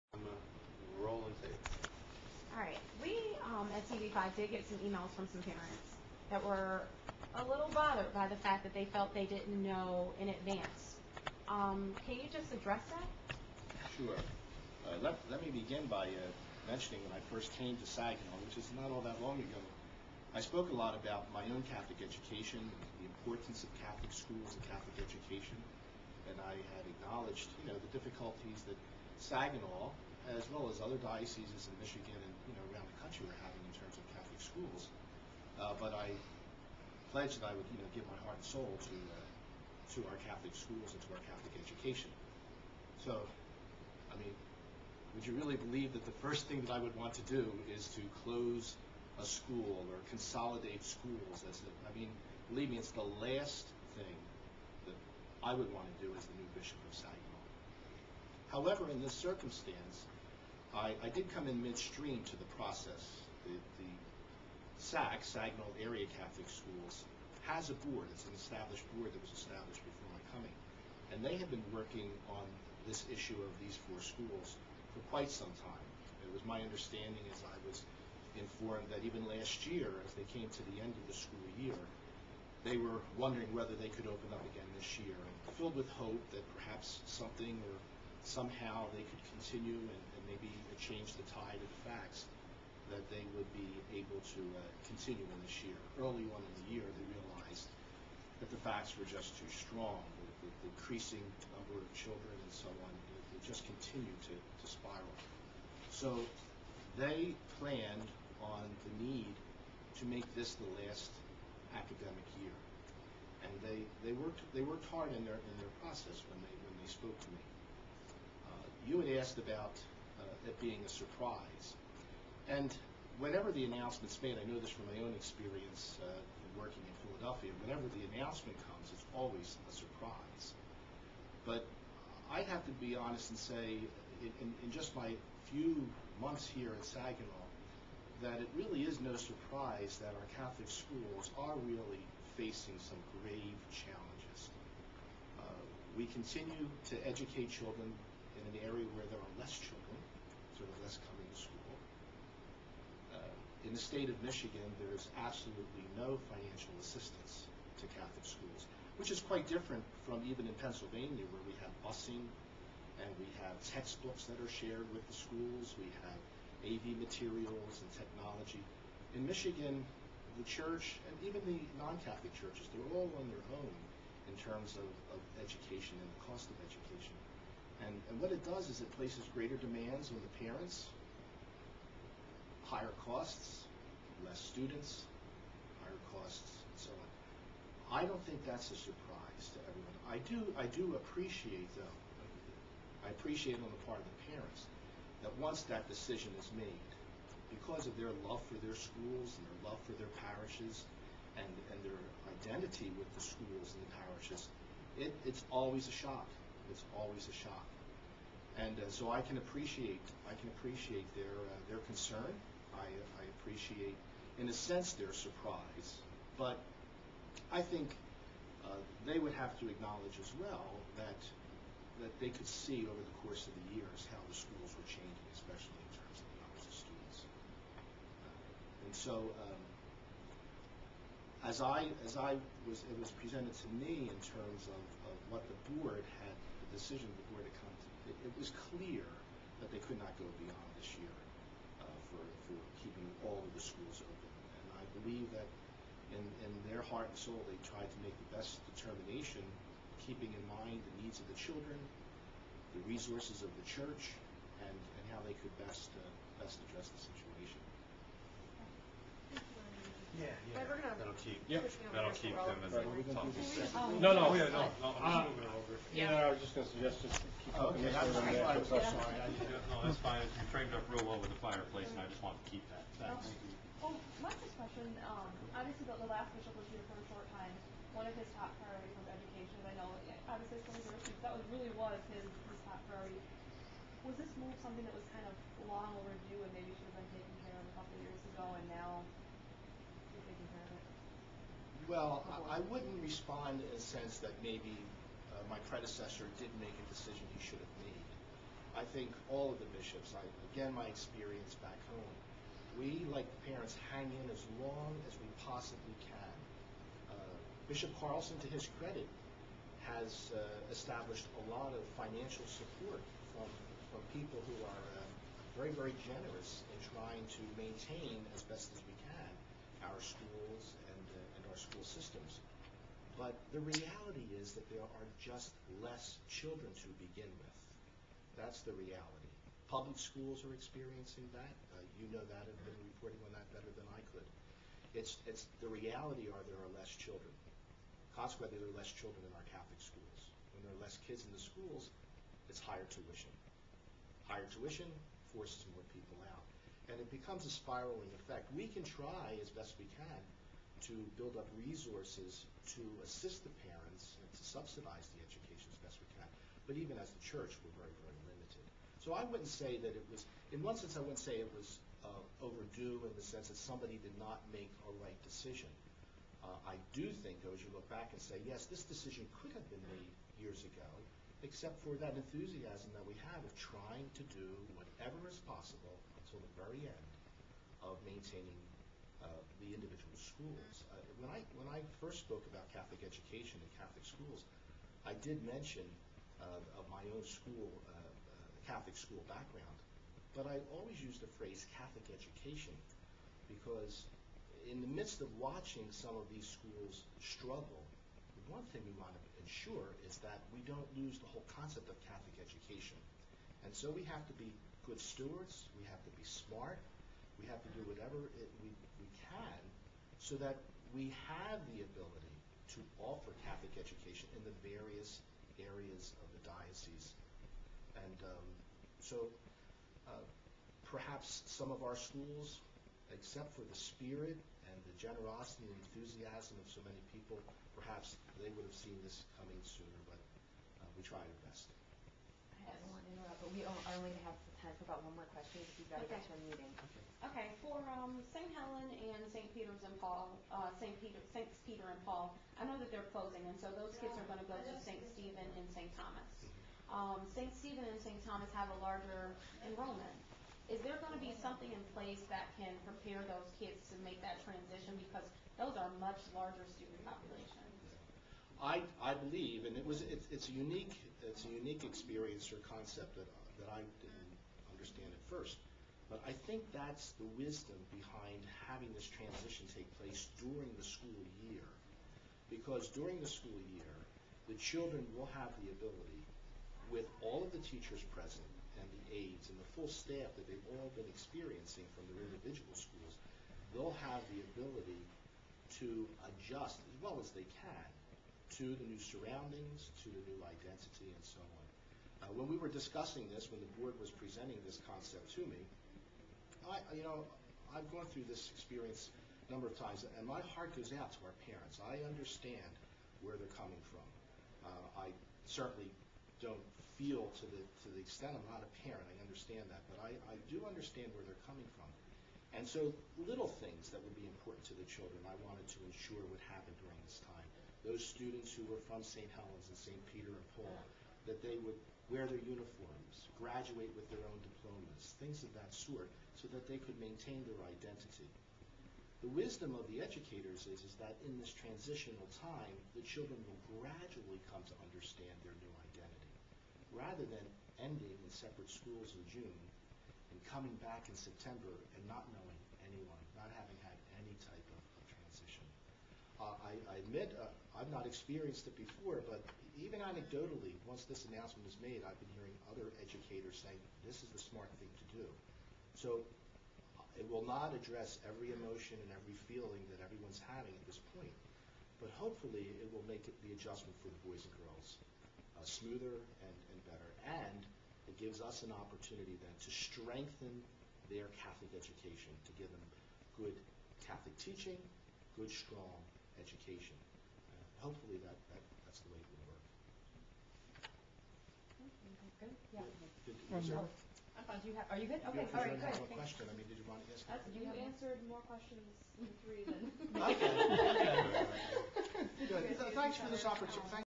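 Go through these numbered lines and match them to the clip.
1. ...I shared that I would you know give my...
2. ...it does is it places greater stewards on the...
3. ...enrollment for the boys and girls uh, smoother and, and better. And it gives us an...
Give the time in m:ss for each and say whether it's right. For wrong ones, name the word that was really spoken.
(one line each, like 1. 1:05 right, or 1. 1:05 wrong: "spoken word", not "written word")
1. 0:35 wrong: "pledged", not "shared"
2. 2:58 wrong: "demands", not "stewards"
3. 9:23 wrong: "adjustment", not "enrollment".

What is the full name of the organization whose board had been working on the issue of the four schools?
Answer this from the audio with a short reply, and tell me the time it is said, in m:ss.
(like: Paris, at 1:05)
Saginaw Area Catholic Schools, at 1:05.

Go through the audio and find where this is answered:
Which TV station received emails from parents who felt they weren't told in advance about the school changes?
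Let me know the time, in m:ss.
0:03.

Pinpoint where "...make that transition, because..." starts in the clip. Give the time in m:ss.
7:34.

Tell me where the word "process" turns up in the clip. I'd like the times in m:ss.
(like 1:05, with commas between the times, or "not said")
1:02, 1:55.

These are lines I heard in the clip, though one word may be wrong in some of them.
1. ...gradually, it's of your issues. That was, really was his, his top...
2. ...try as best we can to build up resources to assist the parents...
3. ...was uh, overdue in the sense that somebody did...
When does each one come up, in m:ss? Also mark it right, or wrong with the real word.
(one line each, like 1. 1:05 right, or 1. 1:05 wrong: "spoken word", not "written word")
1. 4:40 wrong: "obviously", not "gradually"
2. 5:48 right
3. 6:01 right.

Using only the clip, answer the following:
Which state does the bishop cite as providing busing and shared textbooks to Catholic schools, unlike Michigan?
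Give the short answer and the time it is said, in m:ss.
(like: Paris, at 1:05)
Pennsylvania, at 2:40.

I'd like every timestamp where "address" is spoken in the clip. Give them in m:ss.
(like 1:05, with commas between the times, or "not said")
0:12, 4:16, 9:17.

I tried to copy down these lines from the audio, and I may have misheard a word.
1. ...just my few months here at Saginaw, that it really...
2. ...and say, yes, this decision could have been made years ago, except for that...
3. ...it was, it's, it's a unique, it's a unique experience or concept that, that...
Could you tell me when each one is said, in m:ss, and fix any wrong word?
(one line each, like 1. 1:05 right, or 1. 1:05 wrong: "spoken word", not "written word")
1. 2:14 right
2. 6:08 right
3. 7:39 right.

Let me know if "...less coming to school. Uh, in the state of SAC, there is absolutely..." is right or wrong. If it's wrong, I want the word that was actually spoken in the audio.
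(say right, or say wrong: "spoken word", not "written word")
wrong: "Michigan", not "SAC".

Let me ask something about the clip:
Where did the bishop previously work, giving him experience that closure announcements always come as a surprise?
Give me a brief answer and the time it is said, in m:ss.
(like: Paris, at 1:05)
Philadelphia, at 2:07.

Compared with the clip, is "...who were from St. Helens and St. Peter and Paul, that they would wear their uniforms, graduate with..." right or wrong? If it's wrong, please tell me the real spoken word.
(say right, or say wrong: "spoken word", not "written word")
right.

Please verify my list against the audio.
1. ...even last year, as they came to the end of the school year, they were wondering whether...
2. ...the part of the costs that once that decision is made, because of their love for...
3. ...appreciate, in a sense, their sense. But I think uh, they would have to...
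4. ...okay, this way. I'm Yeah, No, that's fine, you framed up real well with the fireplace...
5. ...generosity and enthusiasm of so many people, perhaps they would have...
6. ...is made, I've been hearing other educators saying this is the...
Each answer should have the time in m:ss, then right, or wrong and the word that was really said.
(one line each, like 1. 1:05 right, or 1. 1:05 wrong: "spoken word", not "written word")
1. 1:19 right
2. 3:13 wrong: "parents", not "costs"
3. 3:33 wrong: "surprise", not "sense"
4. 4:27 right
5. 7:05 right
6. 9:11 right.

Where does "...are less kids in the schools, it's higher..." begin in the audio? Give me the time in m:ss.
5:40.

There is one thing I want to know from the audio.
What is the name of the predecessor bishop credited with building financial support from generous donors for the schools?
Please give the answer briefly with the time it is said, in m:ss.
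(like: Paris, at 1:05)
Bishop Carlson, at 5:07.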